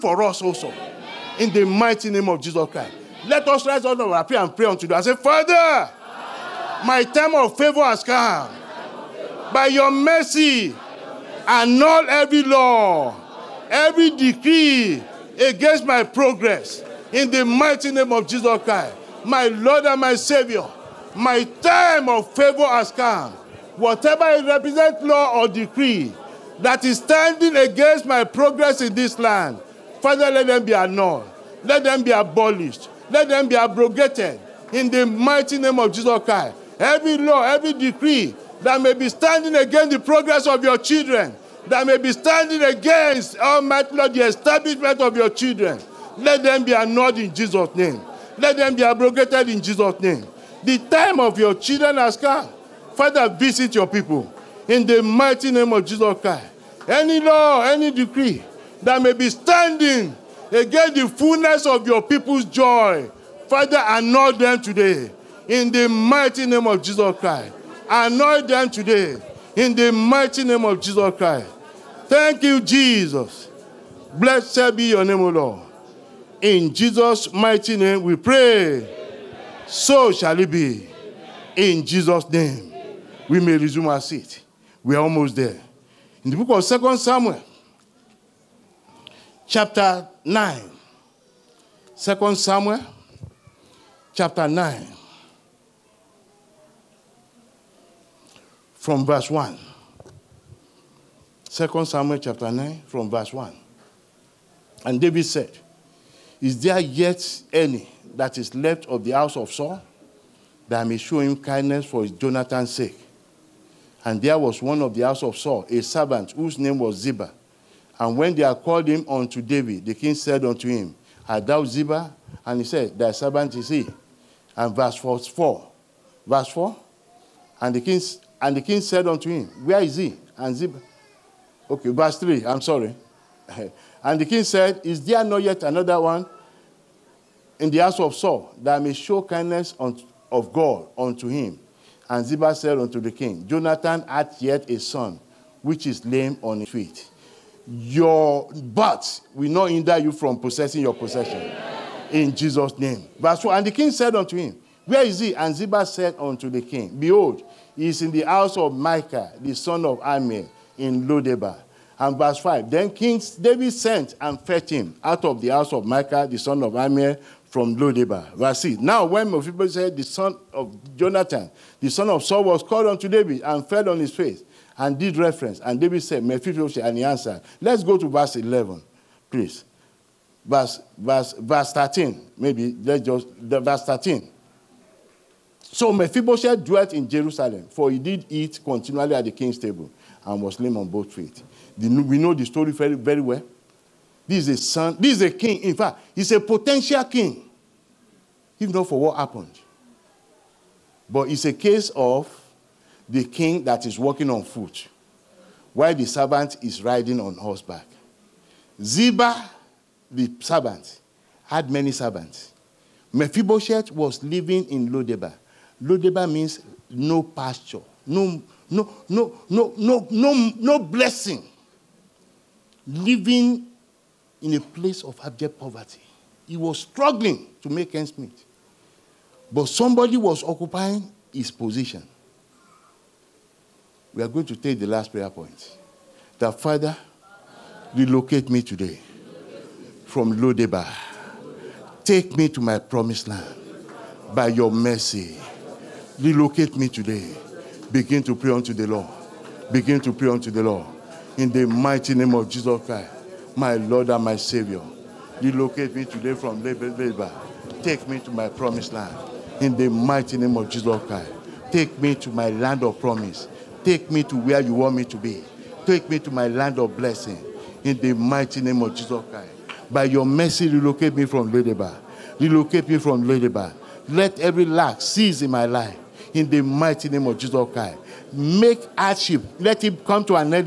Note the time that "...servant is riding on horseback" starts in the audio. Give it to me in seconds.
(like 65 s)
206 s.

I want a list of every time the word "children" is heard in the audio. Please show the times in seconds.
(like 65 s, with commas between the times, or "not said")
40 s, 45 s, 51 s.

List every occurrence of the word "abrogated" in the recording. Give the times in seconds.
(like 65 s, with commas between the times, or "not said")
33 s, 48 s.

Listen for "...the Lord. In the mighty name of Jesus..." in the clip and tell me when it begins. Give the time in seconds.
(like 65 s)
250 s.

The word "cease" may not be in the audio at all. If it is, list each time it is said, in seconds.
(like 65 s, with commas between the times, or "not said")
275 s.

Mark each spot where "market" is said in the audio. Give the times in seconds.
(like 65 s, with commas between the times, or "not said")
not said.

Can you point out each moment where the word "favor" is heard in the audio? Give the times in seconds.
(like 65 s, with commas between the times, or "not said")
7 s, 22 s.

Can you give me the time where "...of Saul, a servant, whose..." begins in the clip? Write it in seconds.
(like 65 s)
115 s.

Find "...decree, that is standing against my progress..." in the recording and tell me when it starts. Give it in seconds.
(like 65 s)
25 s.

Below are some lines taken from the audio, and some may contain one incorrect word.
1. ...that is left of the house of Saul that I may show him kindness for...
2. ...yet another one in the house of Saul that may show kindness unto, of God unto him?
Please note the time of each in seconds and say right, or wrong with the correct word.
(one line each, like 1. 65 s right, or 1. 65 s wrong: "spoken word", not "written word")
1. 108 s right
2. 135 s right.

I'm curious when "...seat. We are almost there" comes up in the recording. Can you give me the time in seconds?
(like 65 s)
84 s.